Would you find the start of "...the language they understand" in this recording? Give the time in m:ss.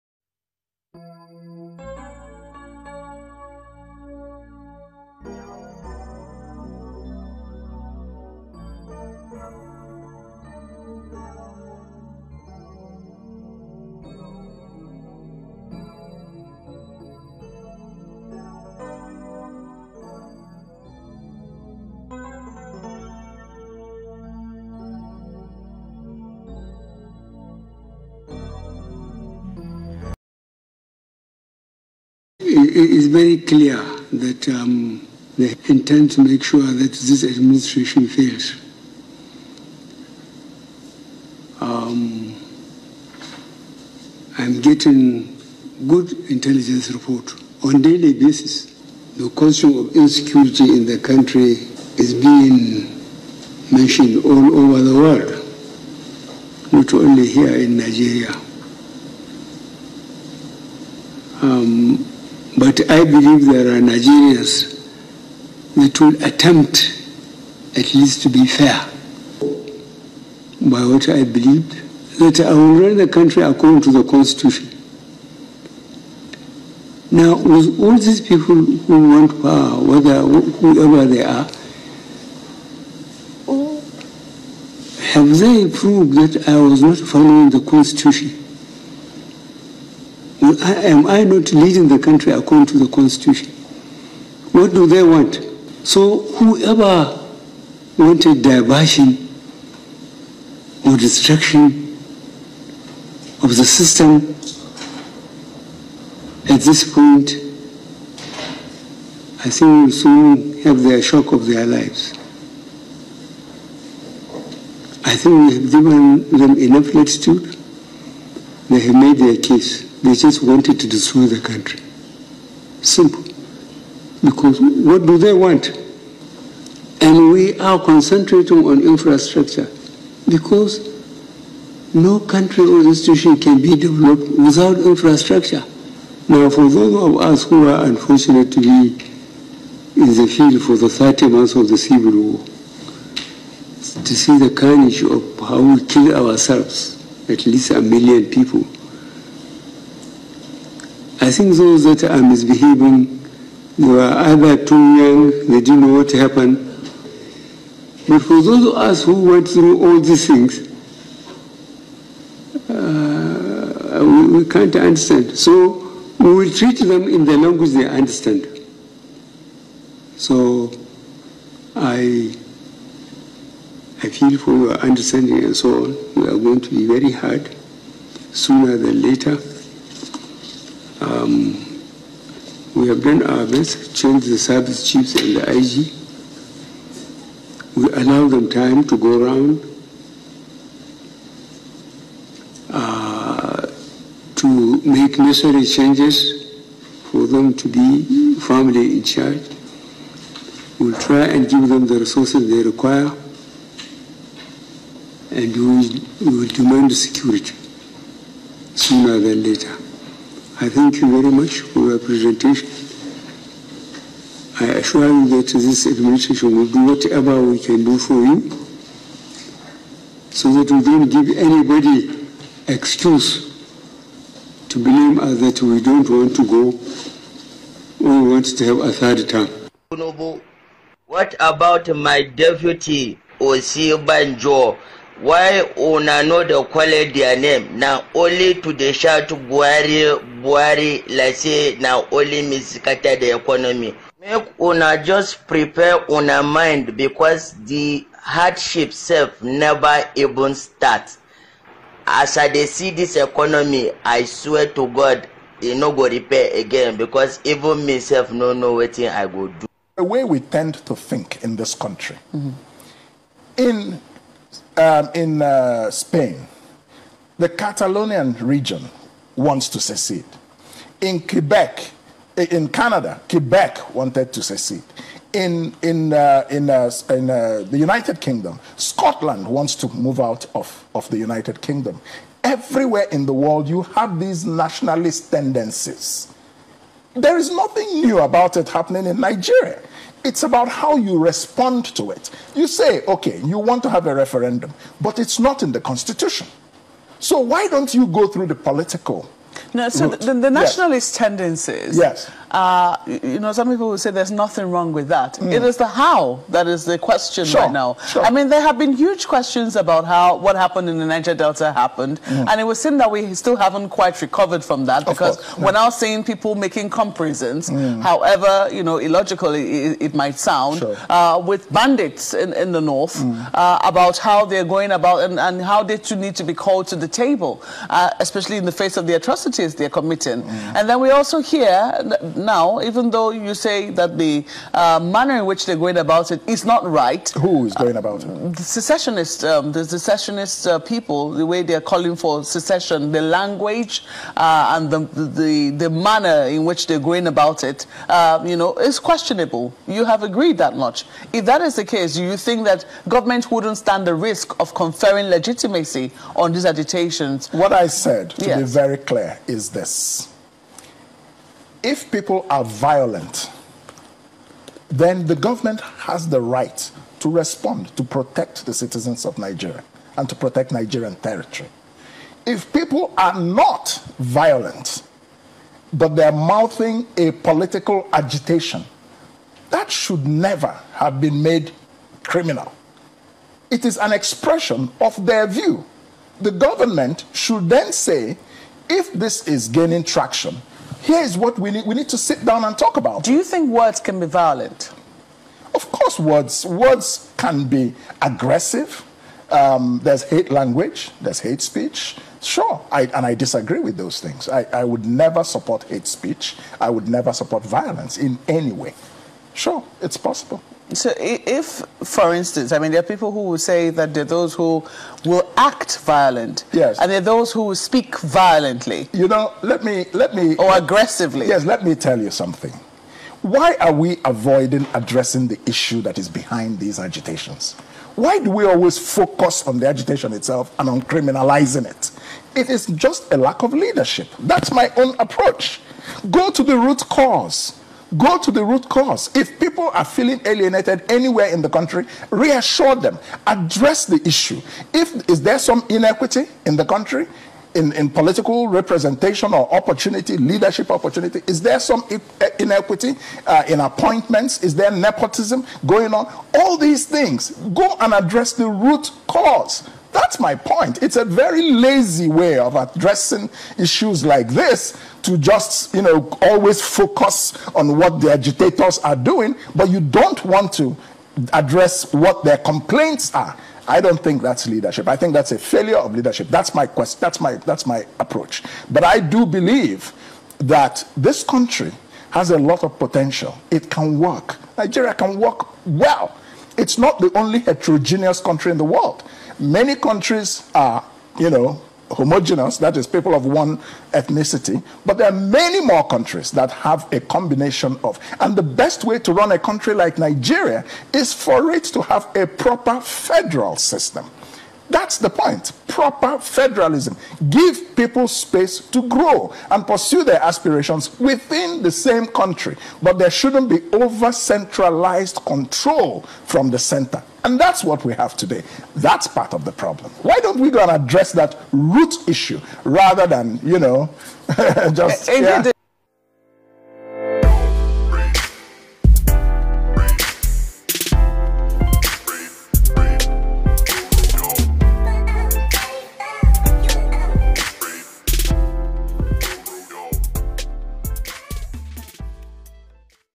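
2:47.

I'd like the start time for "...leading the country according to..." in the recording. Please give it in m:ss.
1:31.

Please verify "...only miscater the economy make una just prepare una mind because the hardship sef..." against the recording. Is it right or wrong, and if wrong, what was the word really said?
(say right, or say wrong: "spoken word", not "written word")
right.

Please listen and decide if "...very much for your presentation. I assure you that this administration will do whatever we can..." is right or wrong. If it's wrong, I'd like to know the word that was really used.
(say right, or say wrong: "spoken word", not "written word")
right.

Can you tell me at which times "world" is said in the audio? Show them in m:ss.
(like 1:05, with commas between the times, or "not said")
0:54, 4:43, 8:08.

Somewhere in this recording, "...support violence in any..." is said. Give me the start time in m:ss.
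6:47.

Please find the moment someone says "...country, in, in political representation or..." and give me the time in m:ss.
7:26.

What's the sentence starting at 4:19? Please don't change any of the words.
the way we tend to think in this country mm-hmm.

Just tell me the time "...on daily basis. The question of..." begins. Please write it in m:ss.
0:47.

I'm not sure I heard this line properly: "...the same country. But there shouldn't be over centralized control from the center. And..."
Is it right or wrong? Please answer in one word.
right.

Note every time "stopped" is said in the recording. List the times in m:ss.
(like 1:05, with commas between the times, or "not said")
not said.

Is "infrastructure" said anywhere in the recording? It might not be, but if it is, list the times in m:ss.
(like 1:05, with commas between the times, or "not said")
2:08, 2:14.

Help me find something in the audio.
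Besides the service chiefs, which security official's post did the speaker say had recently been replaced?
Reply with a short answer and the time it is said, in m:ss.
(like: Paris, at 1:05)
IG, at 3:05.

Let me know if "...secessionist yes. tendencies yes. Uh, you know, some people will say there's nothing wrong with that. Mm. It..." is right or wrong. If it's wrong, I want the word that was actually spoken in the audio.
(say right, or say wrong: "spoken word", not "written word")
wrong: "nationalist", not "secessionist".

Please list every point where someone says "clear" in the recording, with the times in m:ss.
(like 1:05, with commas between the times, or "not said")
0:33, 5:58.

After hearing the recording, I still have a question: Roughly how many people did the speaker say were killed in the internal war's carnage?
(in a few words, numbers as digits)
a million.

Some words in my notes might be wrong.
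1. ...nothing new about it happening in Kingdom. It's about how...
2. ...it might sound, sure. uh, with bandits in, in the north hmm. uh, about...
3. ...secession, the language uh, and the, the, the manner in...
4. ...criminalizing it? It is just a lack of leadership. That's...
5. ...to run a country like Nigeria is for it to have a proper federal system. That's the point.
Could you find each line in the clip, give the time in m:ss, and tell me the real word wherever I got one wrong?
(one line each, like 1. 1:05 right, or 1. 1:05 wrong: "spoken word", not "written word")
1. 4:47 wrong: "Nigeria", not "Kingdom"
2. 5:20 right
3. 5:42 right
4. 7:11 right
5. 8:19 right.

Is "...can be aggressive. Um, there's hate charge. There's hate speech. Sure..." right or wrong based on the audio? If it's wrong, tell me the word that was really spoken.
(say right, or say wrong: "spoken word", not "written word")
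wrong: "language", not "charge".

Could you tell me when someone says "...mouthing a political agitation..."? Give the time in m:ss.
6:16.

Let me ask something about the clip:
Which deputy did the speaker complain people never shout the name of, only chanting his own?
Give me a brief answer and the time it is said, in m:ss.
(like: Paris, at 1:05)
Osinbajo, at 3:53.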